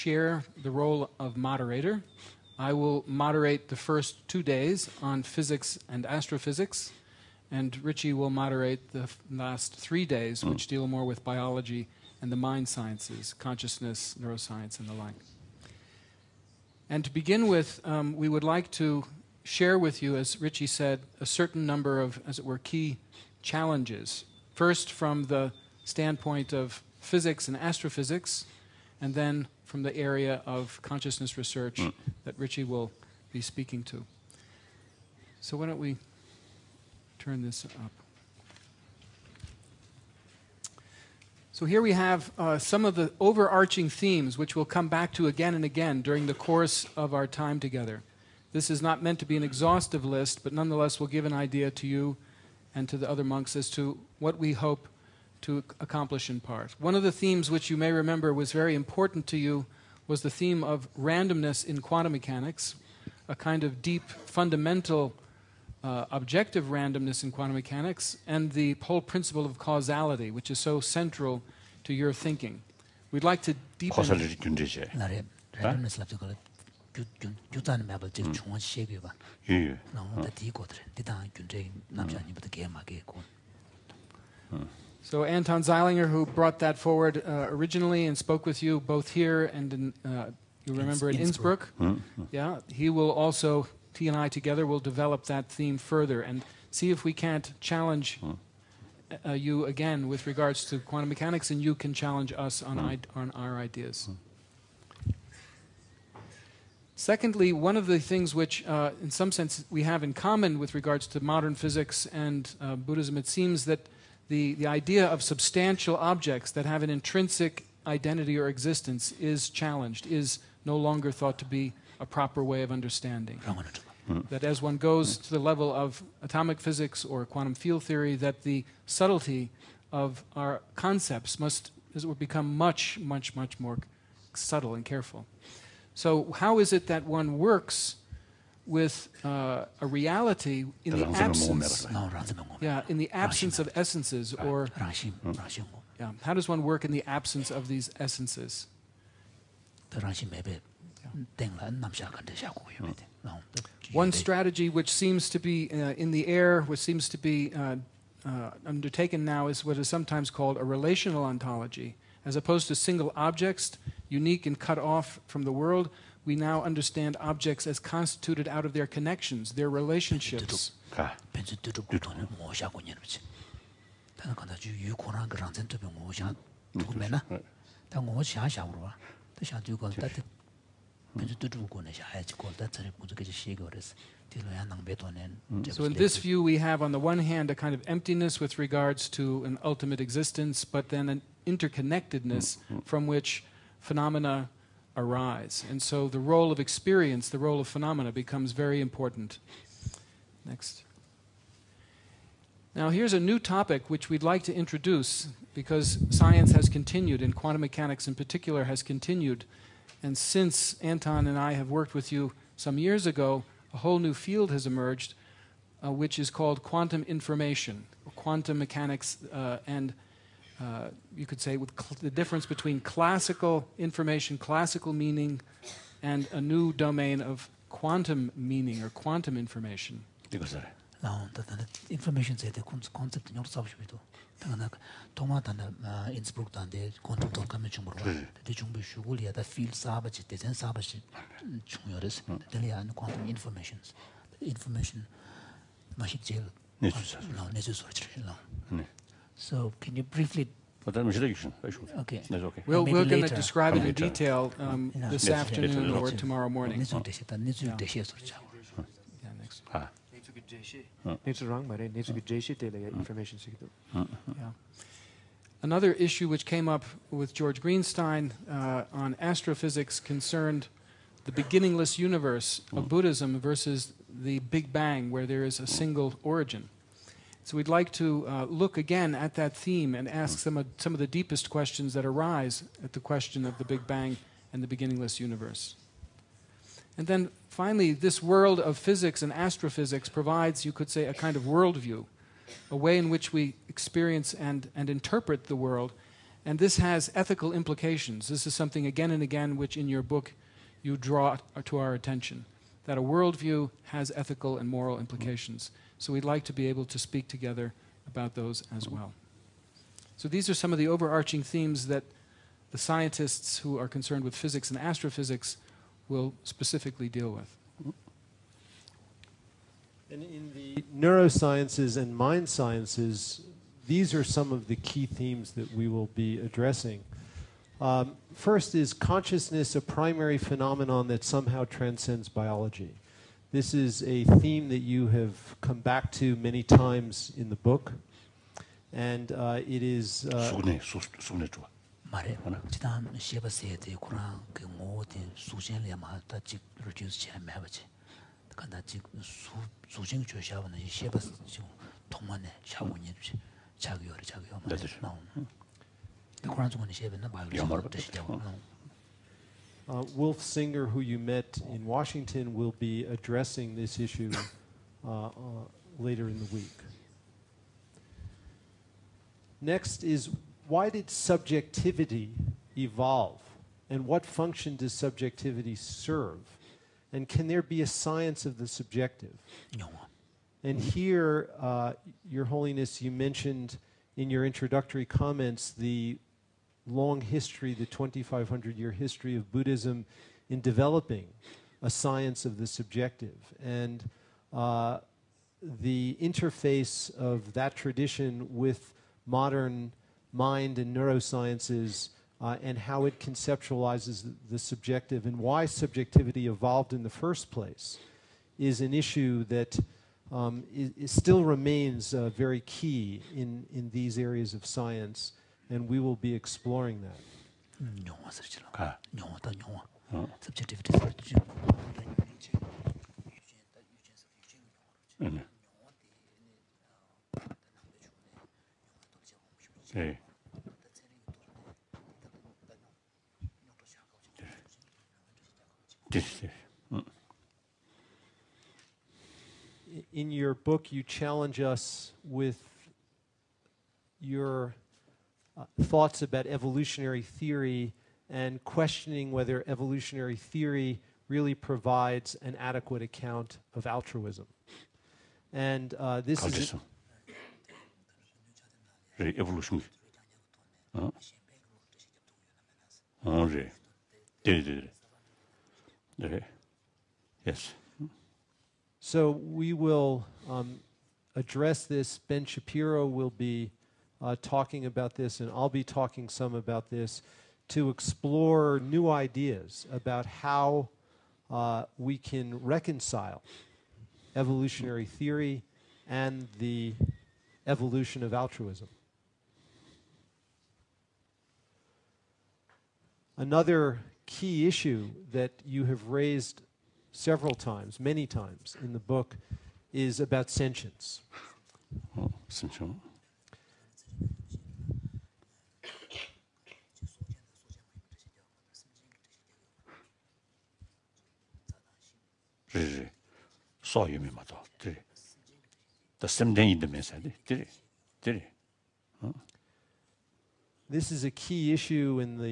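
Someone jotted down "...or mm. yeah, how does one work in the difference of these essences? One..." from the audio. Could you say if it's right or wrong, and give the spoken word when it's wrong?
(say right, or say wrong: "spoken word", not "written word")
wrong: "absence", not "difference".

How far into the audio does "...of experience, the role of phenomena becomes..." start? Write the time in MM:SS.
03:16.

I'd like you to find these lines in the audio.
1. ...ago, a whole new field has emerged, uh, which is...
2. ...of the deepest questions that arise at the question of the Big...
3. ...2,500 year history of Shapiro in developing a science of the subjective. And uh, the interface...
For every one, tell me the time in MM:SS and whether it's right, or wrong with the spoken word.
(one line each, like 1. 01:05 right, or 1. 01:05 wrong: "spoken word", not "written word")
1. 03:33 right
2. 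04:40 right
3. 06:27 wrong: "Buddhism", not "Shapiro".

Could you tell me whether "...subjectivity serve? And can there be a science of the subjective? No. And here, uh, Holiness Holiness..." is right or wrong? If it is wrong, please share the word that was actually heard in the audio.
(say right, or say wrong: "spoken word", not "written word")
wrong: "Your", not "Holiness".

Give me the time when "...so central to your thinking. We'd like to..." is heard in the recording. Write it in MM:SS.
01:10.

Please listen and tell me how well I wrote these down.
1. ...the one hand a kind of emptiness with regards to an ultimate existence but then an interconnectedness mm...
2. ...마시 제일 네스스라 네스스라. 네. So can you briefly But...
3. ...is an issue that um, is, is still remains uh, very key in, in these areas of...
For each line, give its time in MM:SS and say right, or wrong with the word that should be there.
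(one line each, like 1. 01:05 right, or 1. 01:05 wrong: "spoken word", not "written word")
1. 03:06 right
2. 04:05 right
3. 06:48 right.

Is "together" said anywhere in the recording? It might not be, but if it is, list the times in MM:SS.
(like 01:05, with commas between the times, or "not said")
00:47, 01:34, 05:07.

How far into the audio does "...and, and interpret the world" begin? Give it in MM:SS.
04:54.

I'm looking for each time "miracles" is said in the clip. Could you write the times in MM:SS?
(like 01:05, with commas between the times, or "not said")
not said.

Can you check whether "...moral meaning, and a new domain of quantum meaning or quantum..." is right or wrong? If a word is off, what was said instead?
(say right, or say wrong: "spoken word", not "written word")
wrong: "classical", not "moral".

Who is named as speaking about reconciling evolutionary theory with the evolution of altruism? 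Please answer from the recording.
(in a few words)
Ben Shapiro.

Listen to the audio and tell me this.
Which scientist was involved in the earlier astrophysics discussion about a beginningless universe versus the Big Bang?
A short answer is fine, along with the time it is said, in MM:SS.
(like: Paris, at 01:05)
George Greenstein, at 04:27.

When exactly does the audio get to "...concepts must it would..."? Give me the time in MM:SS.
02:10.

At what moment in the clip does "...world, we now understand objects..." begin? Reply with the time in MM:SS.
02:45.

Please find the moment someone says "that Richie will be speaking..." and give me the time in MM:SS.
00:32.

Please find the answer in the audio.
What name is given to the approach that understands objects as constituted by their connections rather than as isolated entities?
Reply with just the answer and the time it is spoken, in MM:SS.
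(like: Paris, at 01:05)
relational ontology, at 02:40.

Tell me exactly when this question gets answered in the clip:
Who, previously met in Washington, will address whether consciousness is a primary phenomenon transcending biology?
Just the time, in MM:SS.
06:00.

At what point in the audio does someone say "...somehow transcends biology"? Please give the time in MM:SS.
05:31.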